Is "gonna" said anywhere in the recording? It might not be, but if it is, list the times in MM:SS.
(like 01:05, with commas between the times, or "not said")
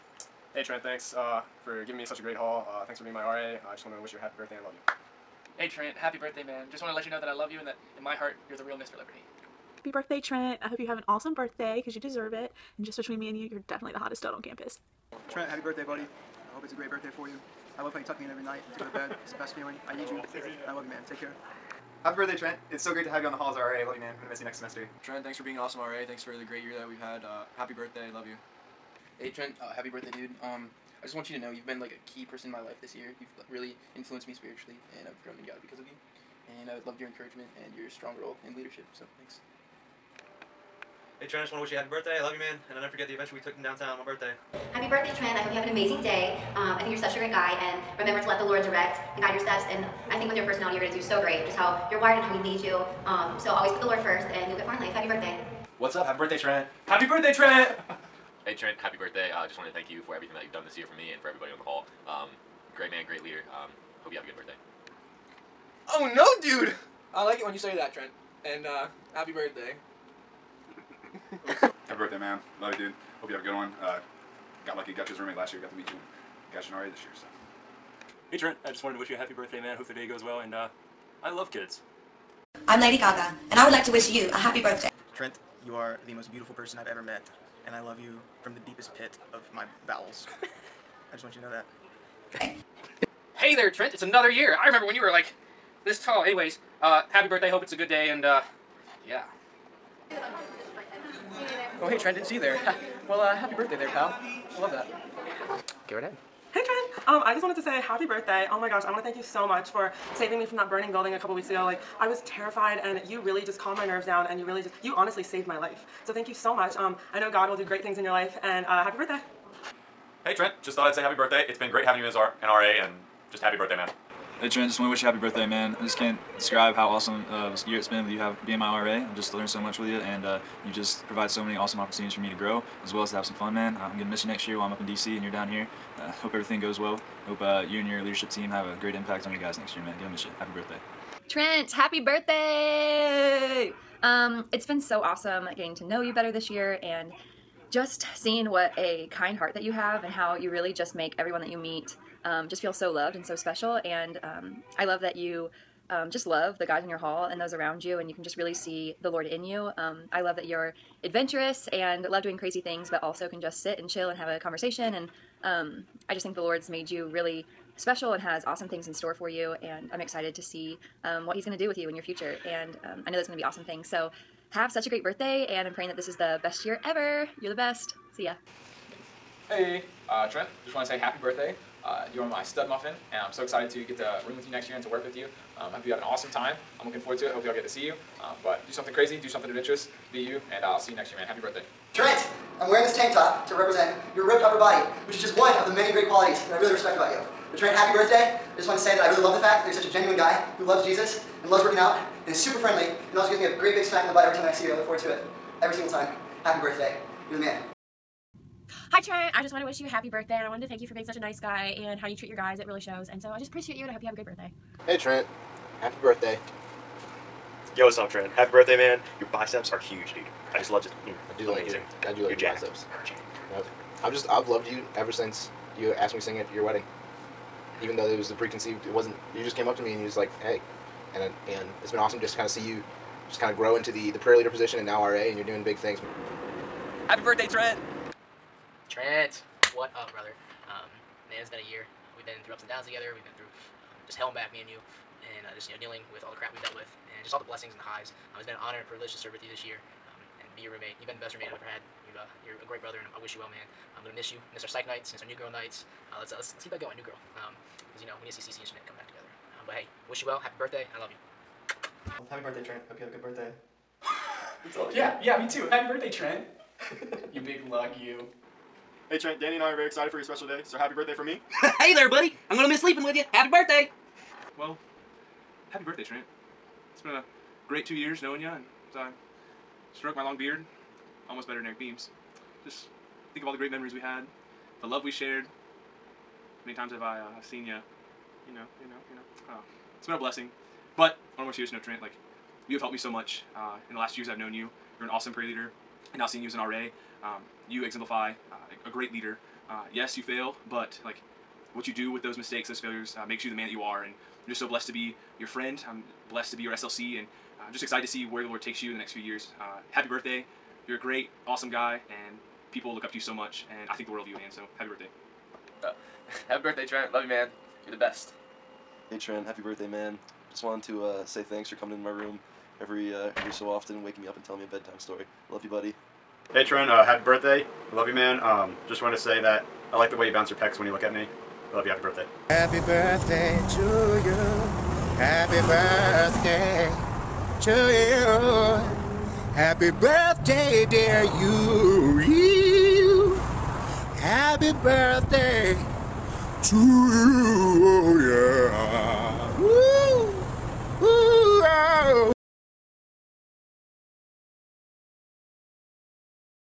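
02:13, 02:19, 04:14, 04:32.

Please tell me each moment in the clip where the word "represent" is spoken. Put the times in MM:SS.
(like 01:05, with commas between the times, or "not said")
03:13.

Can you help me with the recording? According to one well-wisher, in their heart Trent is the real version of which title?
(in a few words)
Mr. Liberty.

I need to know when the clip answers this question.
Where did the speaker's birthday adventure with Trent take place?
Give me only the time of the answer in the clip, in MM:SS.
00:43.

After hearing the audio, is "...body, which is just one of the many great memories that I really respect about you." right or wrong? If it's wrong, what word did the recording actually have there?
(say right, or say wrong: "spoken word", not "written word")
wrong: "qualities", not "memories".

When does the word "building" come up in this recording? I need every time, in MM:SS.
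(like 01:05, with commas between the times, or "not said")
01:50.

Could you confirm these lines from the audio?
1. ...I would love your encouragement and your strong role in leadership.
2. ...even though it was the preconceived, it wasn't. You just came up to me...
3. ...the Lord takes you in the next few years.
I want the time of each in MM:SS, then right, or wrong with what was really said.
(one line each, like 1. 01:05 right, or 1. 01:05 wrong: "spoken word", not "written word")
1. 00:36 right
2. 03:47 right
3. 05:08 right.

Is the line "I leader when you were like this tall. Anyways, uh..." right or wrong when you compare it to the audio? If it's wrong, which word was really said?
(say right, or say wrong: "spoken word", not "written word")
wrong: "remember", not "leader".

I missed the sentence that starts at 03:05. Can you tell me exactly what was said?
Um, I hope you have an awesome time.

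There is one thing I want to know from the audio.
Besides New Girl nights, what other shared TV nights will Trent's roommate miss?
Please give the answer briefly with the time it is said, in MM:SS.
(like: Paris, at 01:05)
psych nights, at 04:14.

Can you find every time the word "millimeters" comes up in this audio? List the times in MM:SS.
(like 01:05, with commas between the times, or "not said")
not said.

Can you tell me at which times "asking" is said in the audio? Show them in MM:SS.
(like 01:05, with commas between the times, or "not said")
not said.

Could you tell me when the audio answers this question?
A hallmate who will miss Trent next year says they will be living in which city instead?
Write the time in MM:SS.
02:14.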